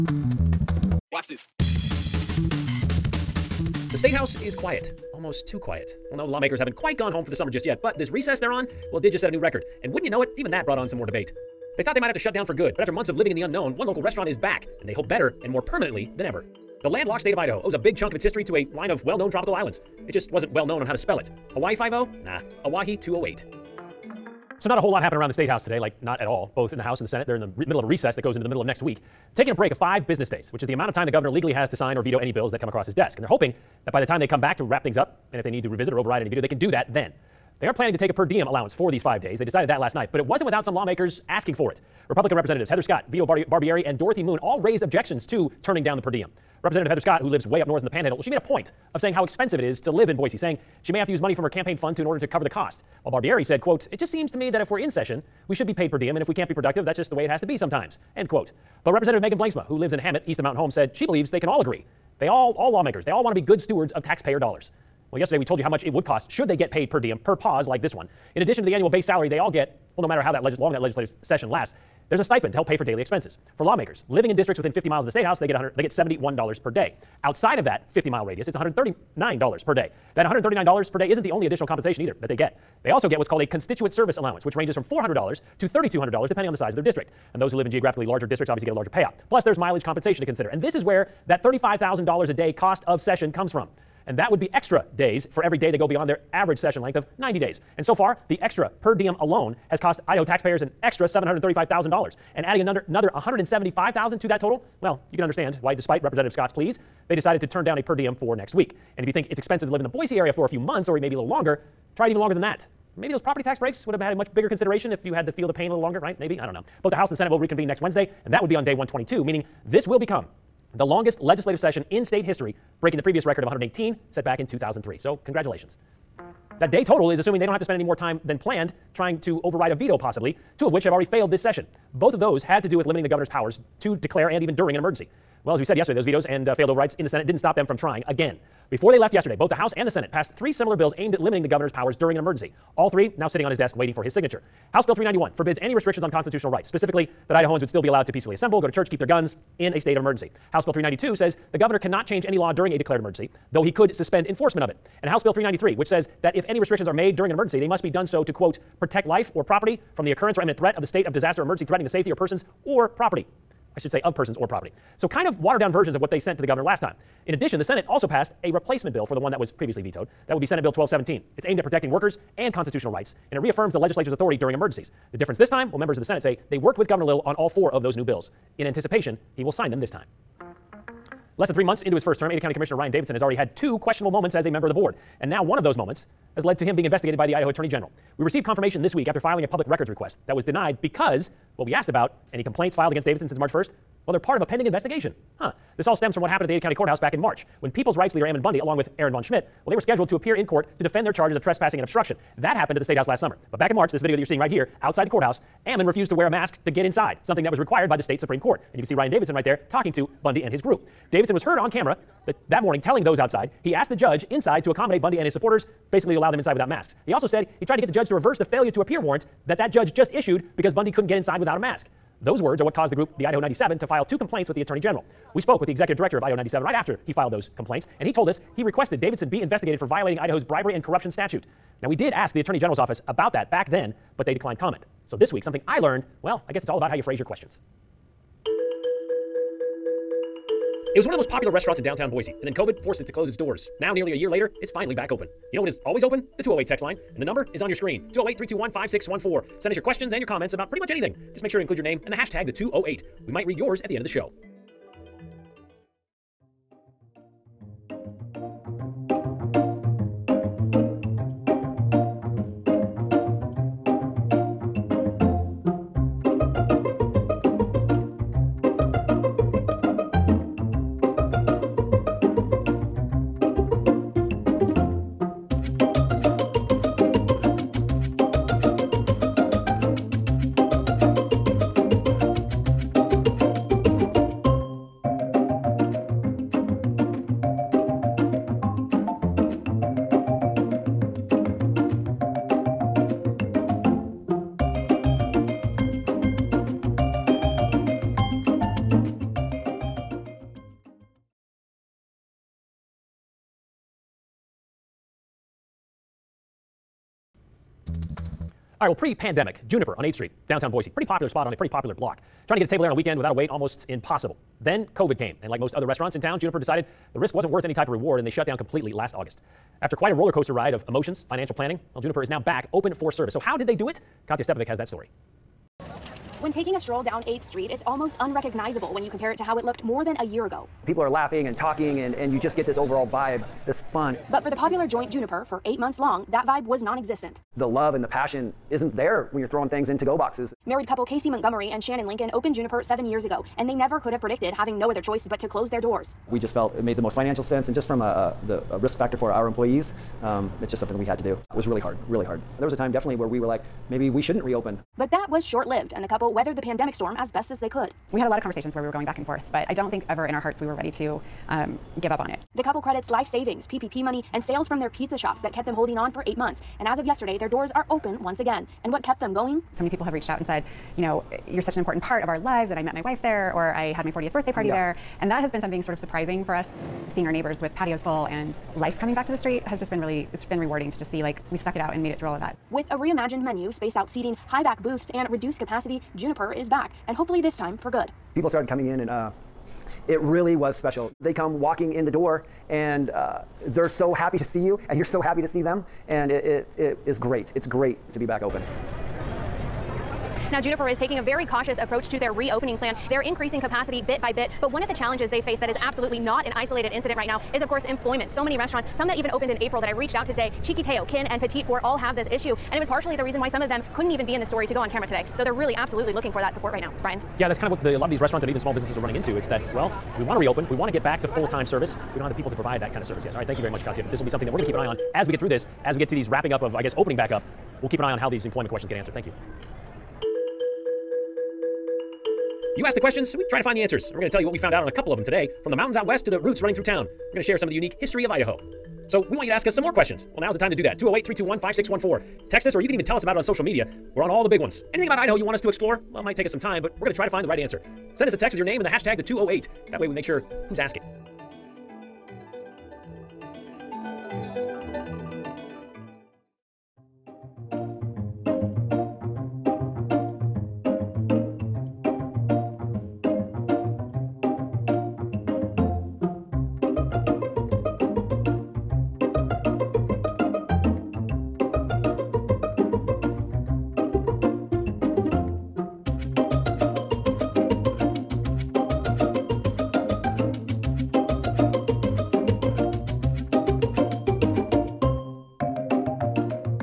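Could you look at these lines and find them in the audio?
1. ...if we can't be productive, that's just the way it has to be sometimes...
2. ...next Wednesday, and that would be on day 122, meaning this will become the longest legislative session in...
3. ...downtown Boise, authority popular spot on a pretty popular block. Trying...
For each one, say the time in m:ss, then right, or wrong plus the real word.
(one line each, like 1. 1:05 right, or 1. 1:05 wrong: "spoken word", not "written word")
1. 0:56 right
2. 1:57 right
3. 5:10 wrong: "pretty", not "authority".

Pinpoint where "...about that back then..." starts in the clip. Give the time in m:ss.
3:53.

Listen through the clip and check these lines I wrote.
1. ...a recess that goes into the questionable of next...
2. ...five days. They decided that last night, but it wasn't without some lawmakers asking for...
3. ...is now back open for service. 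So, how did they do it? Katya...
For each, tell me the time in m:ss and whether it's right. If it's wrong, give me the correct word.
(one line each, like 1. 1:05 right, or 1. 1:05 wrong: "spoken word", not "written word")
1. 0:27 wrong: "middle", not "questionable"
2. 0:39 right
3. 5:22 right.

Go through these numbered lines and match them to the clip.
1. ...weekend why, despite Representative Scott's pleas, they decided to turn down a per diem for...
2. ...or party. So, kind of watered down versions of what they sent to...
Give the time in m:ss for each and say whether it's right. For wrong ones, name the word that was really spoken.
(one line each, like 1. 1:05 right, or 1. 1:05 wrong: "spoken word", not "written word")
1. 1:45 wrong: "understand", not "weekend"
2. 2:44 wrong: "property", not "party".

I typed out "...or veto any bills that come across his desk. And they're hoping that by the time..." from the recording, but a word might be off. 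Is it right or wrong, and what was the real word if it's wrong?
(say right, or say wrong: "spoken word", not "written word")
right.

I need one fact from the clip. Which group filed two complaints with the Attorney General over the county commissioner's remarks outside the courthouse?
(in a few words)
Idaho 97.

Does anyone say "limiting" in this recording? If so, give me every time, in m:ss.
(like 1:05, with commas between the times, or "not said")
2:12, 2:21.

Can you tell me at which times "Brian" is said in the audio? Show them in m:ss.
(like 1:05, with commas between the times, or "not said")
6:57.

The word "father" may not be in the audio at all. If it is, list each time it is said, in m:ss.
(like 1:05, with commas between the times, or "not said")
not said.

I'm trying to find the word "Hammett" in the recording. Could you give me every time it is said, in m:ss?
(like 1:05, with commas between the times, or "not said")
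0:59.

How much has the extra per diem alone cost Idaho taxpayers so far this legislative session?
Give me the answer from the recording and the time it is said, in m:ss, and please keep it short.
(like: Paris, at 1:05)
$735,000, at 1:41.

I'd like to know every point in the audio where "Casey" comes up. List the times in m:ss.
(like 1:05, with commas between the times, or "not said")
5:41.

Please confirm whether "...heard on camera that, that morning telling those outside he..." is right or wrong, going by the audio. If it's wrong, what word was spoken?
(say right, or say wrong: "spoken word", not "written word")
right.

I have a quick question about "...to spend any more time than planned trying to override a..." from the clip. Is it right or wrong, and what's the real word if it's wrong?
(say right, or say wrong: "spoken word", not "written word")
right.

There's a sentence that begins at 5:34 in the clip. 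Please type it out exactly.
But for the popular joint Juniper, for eight months long, that vibe was non existent.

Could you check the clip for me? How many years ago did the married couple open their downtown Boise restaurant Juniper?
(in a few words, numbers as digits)
7.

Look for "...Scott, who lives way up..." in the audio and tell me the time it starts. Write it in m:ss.
0:47.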